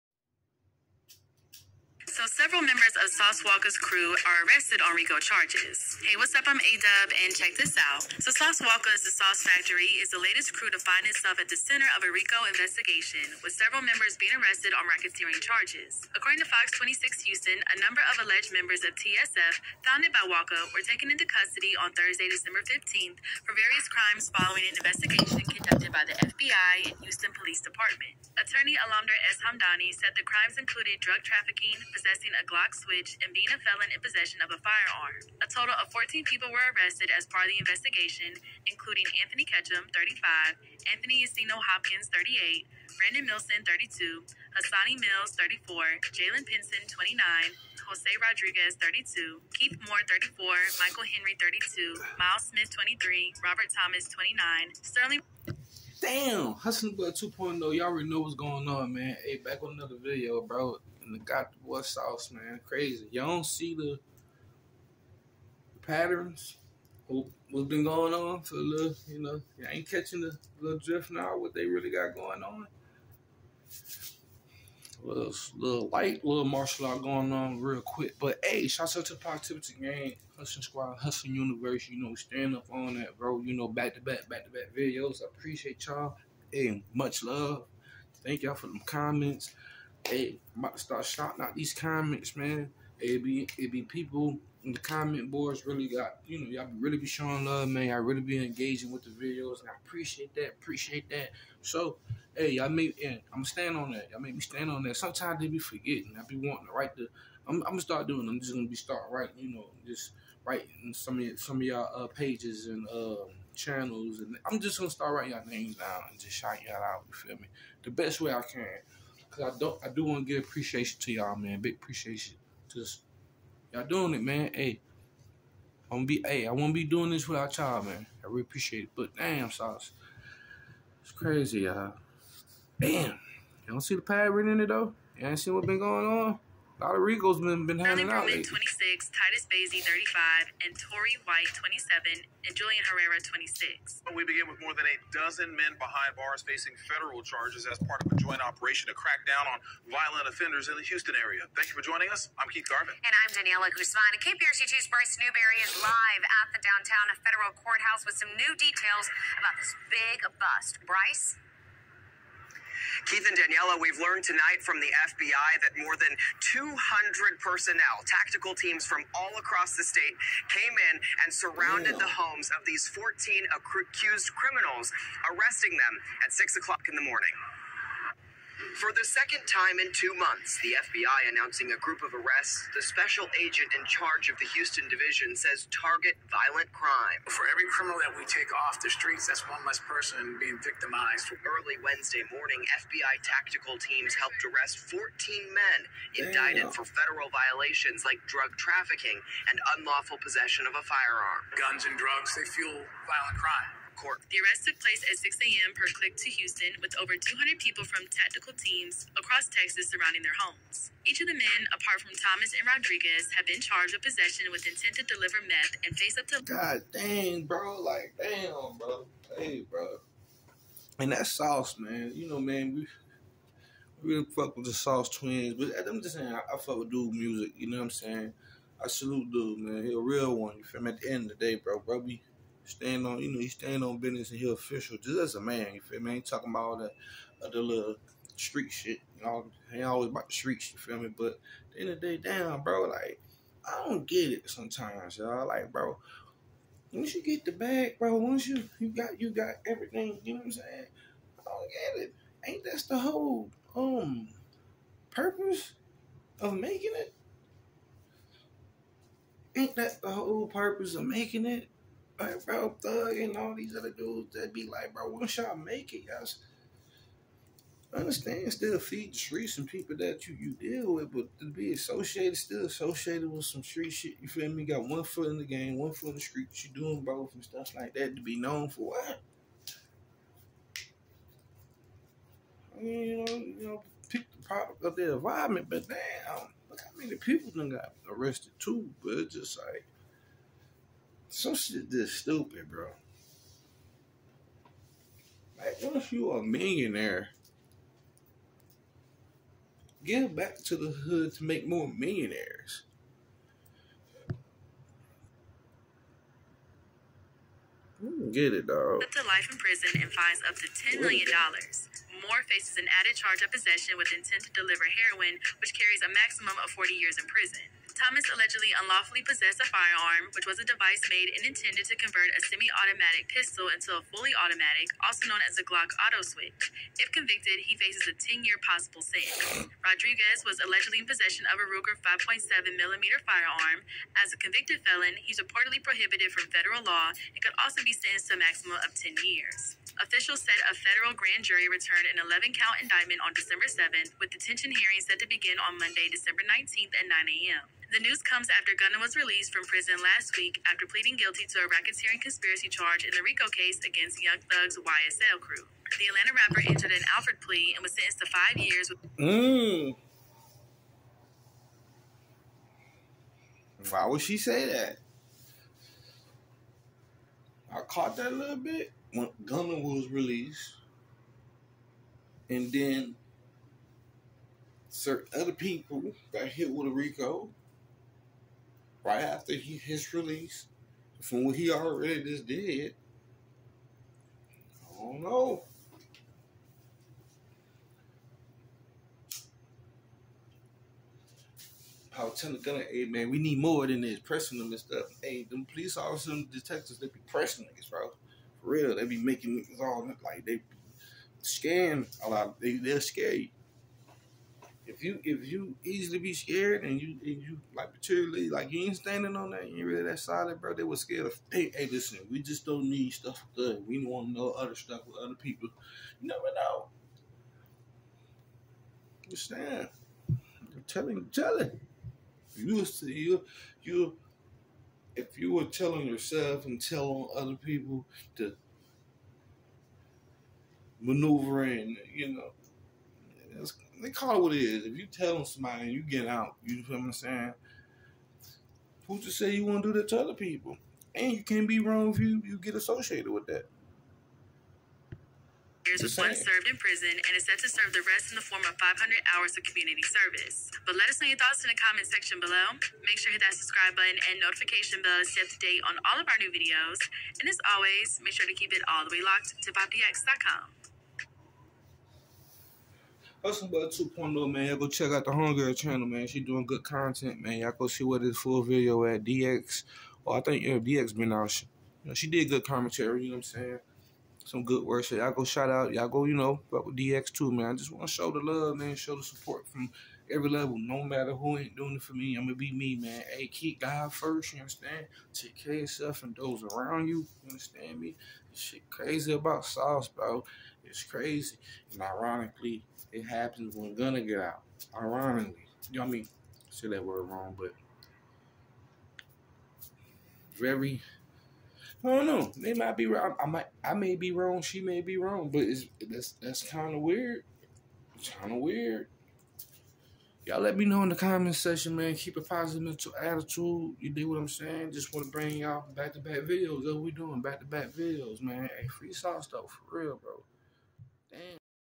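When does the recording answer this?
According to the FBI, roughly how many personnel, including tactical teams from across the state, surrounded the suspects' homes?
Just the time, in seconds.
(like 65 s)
165 s.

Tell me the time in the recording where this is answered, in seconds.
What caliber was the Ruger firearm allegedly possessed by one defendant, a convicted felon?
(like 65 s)
331 s.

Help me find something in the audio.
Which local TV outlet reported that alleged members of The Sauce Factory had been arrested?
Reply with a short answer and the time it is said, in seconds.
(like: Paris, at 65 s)
Fox 26 Houston, at 16 s.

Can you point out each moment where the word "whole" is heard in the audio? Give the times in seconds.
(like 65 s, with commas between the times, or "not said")
252 s, 260 s.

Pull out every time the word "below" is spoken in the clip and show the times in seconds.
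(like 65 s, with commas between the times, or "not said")
452 s.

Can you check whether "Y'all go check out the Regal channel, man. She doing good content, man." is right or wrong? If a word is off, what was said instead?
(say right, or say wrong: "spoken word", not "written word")
wrong: "Homegirl", not "Regal".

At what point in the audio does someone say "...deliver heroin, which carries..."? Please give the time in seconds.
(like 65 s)
314 s.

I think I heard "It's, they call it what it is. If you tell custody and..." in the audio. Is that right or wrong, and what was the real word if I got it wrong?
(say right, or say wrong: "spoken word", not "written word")
wrong: "somebody", not "custody".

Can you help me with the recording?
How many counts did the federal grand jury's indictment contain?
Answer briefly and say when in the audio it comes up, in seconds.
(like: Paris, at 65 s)
11, at 342 s.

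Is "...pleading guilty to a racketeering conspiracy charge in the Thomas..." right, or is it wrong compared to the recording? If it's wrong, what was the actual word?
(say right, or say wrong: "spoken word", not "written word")
wrong: "RICO", not "Thomas".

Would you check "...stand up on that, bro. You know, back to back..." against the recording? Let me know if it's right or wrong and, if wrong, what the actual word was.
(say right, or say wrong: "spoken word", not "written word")
right.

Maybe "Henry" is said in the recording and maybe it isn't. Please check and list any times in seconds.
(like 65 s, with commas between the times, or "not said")
51 s.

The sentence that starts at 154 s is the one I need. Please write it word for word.
KPRC2's Bryce Newberry is live at the downtown federal courthouse with some new details about this big bust.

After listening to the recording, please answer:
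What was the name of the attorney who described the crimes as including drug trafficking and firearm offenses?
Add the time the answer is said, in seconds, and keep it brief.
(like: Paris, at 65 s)
Alamdar S. Hamdani, at 28 s.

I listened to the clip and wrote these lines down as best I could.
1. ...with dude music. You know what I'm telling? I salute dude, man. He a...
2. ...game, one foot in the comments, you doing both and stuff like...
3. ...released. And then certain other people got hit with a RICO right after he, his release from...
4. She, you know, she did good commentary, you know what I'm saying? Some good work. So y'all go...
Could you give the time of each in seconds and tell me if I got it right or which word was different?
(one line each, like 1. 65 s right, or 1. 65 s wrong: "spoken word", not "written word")
1. 226 s wrong: "saying", not "telling"
2. 275 s wrong: "streets", not "comments"
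3. 370 s right
4. 471 s right.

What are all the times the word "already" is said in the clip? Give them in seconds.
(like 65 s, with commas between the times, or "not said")
57 s, 381 s.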